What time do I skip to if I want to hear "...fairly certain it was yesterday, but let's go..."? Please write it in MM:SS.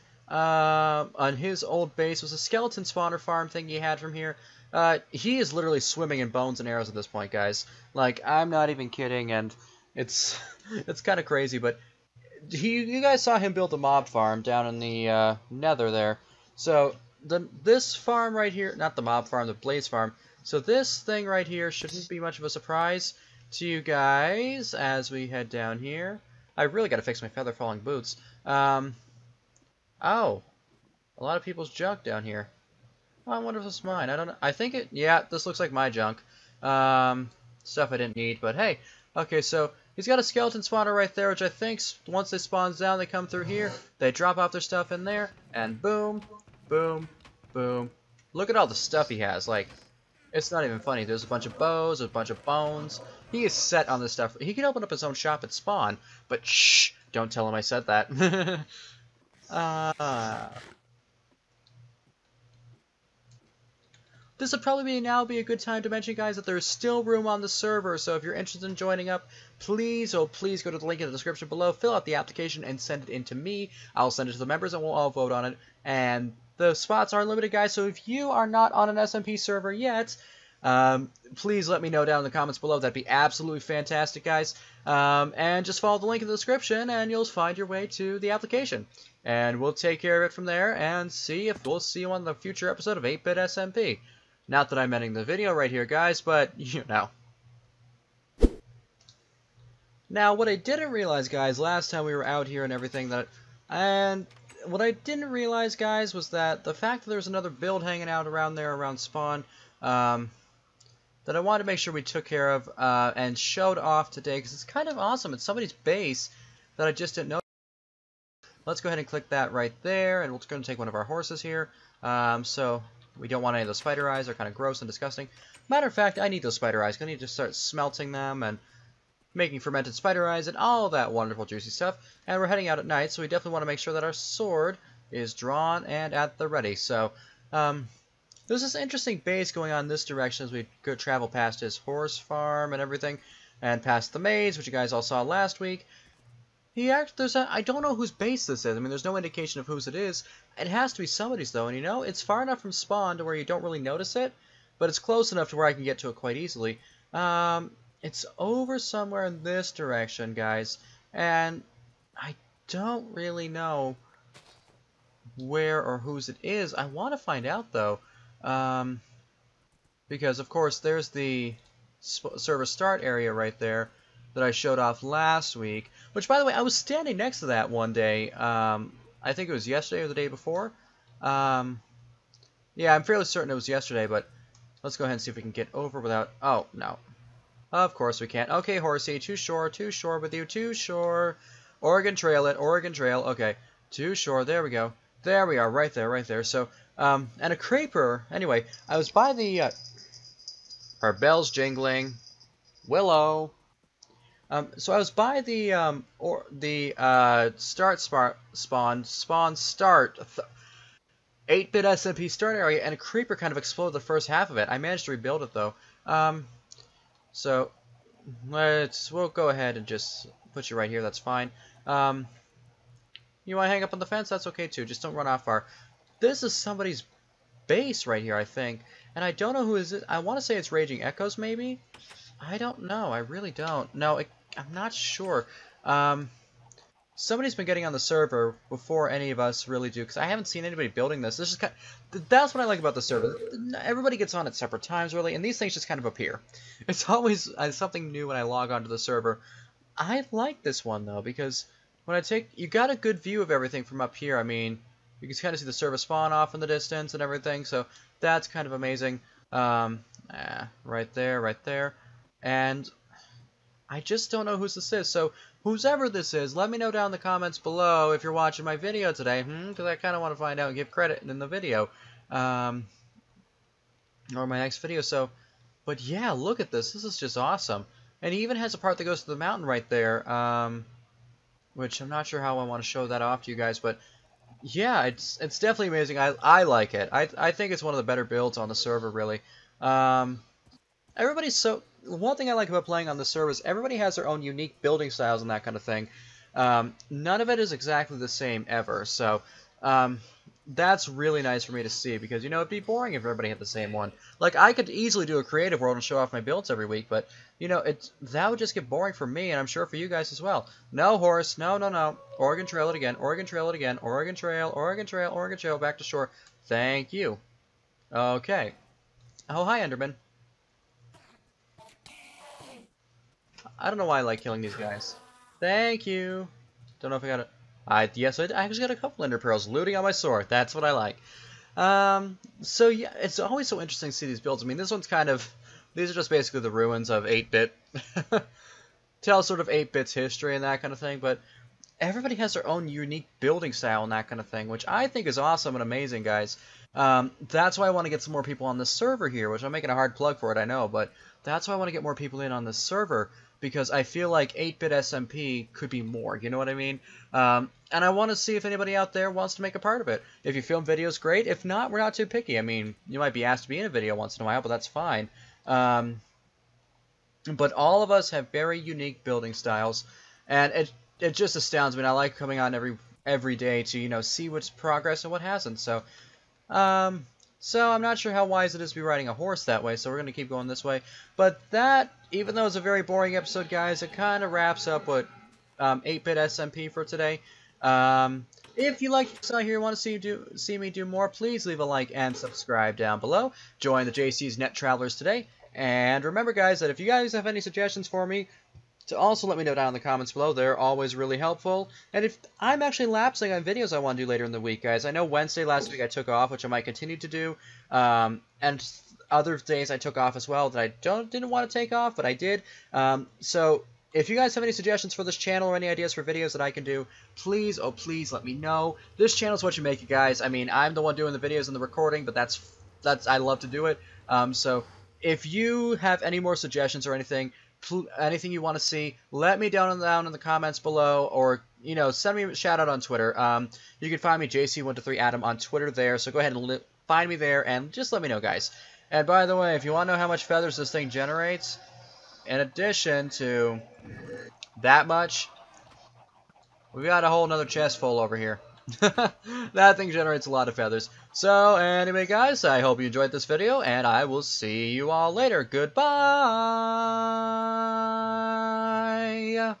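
03:03.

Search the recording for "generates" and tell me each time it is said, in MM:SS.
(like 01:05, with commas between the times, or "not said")
07:21, 07:30.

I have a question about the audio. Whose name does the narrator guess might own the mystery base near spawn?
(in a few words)
Raging Echoes.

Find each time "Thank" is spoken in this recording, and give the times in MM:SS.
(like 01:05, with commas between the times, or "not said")
05:16, 05:25.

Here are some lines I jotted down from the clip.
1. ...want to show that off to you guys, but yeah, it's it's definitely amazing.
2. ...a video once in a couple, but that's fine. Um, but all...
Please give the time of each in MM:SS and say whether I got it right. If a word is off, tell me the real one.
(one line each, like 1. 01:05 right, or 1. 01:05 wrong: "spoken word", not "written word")
1. 04:42 right
2. 06:03 wrong: "while", not "couple".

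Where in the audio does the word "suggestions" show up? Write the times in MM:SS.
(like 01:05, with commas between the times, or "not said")
06:37, 06:54, 07:06.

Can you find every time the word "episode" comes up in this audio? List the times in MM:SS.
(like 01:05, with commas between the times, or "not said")
01:32, 06:23.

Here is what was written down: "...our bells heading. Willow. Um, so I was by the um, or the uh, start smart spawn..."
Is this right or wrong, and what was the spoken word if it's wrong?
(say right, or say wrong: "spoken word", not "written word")
wrong: "jingling", not "heading".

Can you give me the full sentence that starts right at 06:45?
I know Wednesday last week I took off, which I might continue to do.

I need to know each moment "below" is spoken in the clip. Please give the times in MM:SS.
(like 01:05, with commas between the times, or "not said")
01:11, 01:22, 04:27, 06:33, 06:40, 07:10.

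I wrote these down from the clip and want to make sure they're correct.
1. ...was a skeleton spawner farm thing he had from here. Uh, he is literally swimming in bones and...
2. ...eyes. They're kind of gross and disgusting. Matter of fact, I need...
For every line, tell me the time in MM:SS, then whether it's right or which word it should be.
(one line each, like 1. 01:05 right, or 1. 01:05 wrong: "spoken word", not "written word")
1. 00:02 right
2. 02:04 right.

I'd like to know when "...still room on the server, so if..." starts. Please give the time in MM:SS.
01:06.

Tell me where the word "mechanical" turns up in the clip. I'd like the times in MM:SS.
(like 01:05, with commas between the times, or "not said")
not said.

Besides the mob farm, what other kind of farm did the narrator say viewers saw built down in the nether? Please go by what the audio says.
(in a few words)
Blaze farm.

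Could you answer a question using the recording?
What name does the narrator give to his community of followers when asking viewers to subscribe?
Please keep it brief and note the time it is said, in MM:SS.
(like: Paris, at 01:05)
JC's Net Travelers, at 06:34.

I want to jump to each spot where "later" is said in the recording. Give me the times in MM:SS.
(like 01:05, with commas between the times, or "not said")
06:44, 07:35.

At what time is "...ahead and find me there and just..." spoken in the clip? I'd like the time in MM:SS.
07:16.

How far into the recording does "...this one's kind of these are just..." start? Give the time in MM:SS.
05:34.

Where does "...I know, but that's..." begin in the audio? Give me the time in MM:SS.
05:50.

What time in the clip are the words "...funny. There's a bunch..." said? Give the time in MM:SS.
00:50.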